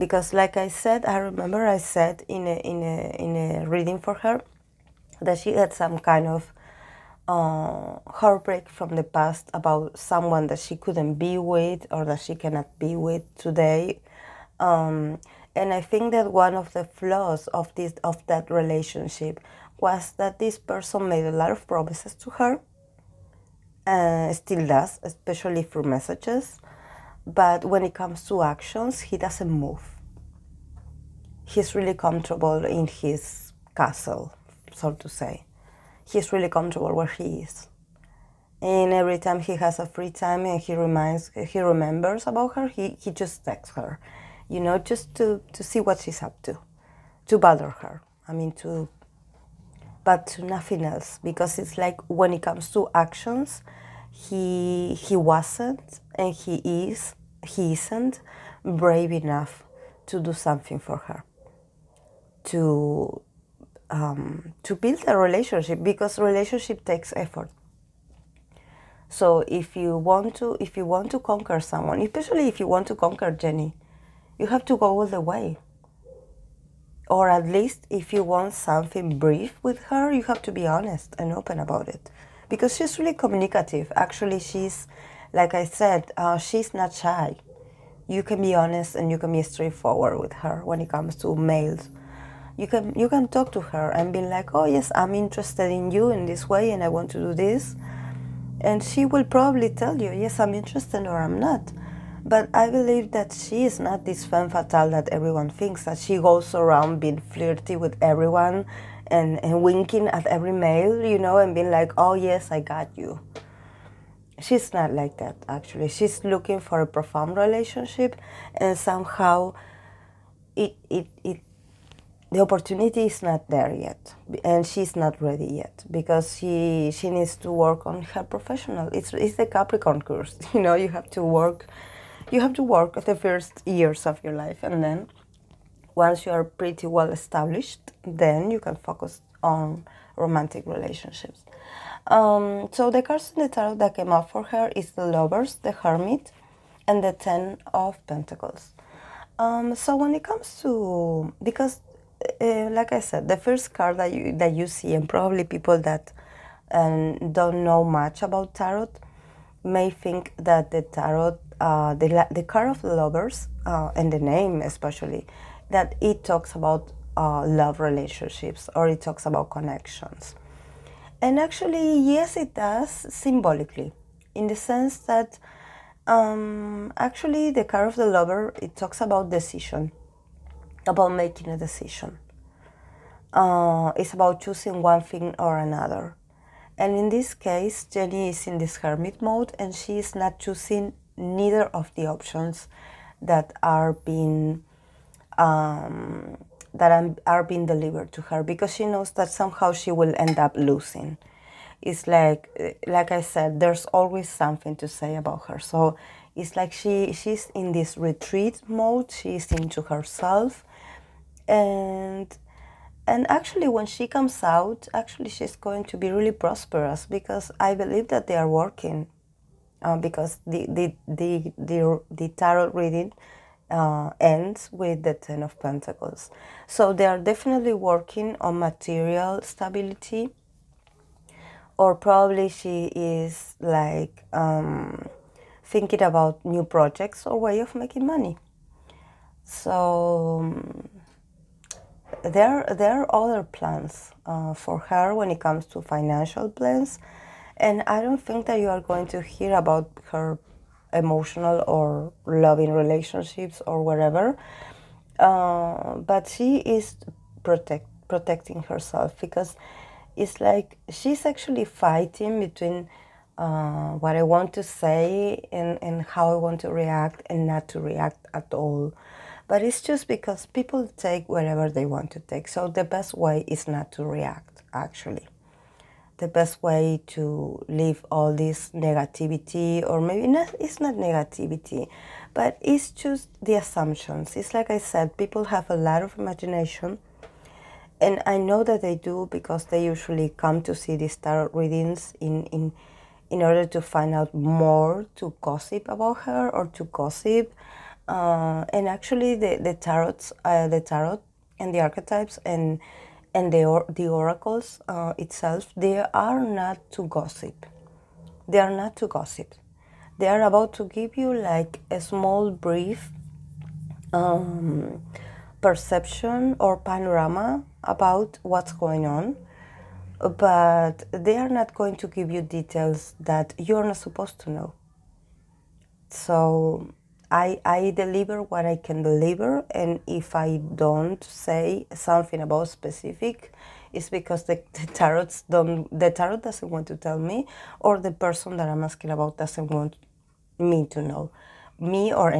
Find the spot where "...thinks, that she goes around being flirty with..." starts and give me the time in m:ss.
1:45.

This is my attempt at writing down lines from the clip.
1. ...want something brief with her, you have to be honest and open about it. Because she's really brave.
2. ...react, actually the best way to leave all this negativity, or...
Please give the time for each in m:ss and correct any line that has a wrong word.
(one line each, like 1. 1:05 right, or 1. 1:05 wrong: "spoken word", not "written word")
1. 1:18 wrong: "communicative", not "brave"
2. 4:34 right.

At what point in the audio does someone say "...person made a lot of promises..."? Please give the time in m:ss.
0:20.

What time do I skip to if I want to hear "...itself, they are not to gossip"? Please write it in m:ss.
5:05.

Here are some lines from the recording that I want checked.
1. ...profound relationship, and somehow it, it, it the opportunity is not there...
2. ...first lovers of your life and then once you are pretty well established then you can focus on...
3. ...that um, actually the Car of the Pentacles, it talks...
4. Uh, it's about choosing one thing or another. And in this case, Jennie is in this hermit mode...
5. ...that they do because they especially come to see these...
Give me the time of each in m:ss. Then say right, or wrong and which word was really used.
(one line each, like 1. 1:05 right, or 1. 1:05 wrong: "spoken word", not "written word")
1. 1:56 right
2. 2:13 wrong: "years", not "lovers"
3. 2:54 wrong: "Lover", not "Pentacles"
4. 3:03 right
5. 4:48 wrong: "usually", not "especially".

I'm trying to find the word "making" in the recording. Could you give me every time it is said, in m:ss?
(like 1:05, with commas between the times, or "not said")
3:01, 3:57.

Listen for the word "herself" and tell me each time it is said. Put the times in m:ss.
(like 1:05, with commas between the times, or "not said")
3:29, 4:18.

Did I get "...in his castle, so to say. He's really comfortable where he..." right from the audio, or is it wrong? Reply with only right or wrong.
right.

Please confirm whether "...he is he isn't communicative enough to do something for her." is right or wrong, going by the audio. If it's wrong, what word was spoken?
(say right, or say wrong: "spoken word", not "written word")
wrong: "brave", not "communicative".